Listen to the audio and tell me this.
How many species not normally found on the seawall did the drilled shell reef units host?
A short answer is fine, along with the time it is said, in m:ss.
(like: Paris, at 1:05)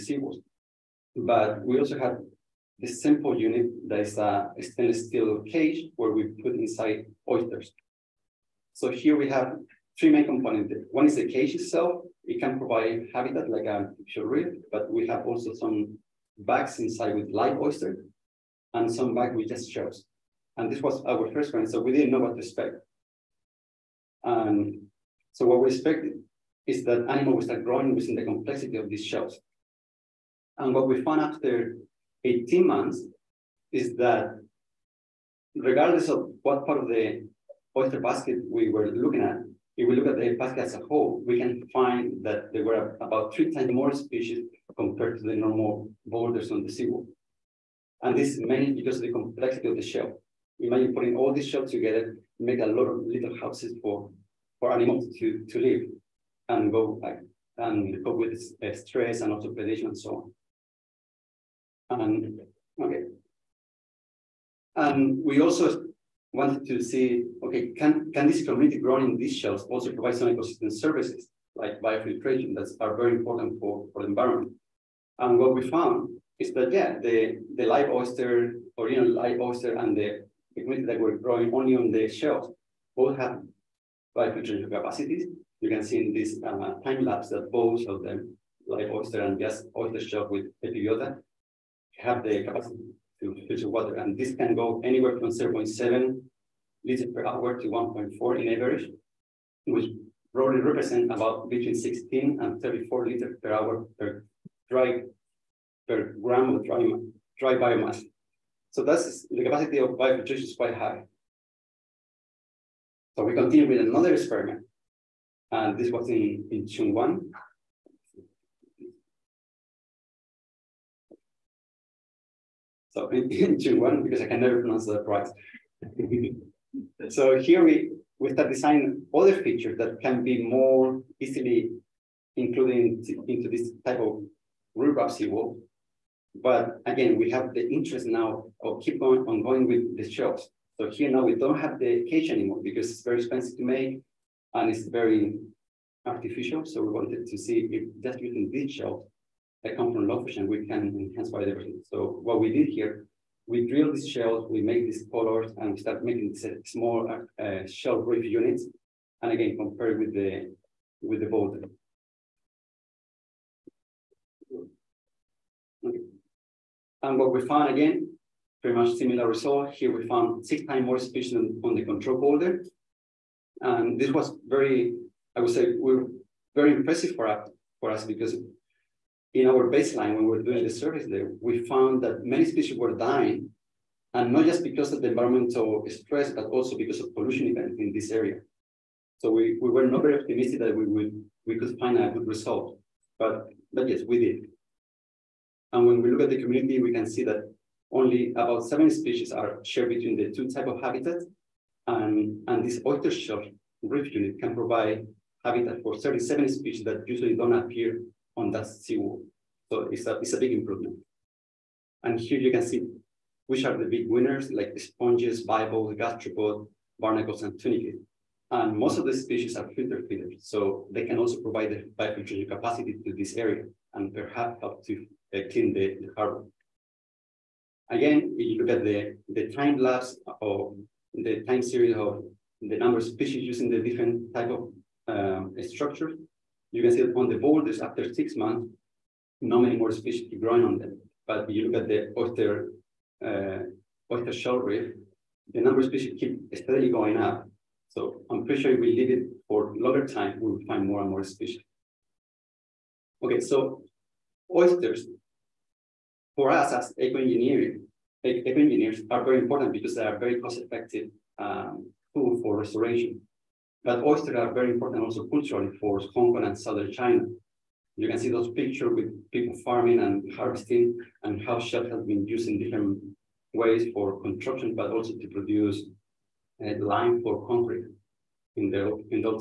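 37, at 3:25.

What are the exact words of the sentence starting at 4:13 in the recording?
Okay, so oysters, for us as eco-engineering, eco-engineers are very important because they are very cost-effective um, tool for restoration.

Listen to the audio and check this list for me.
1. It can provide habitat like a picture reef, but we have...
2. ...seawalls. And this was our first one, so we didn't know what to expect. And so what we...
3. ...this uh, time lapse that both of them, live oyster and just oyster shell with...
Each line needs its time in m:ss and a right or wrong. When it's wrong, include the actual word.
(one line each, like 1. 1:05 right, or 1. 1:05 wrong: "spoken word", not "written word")
1. 0:12 right
2. 0:19 wrong: "shells", not "seawalls"
3. 1:26 right.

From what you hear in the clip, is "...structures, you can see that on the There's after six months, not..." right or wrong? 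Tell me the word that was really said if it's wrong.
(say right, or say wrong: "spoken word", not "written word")
right.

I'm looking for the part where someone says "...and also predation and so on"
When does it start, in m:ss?
0:59.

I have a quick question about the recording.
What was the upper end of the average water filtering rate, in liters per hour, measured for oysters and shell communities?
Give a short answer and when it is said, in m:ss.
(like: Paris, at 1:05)
1.4, at 1:37.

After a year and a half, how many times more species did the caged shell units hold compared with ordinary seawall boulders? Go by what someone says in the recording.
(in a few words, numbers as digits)
3 times.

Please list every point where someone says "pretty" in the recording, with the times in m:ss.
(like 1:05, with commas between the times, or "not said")
2:48, 4:08.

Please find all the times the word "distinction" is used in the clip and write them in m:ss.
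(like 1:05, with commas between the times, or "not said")
not said.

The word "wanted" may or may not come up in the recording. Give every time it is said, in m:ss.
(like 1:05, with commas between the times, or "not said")
1:06, 2:26.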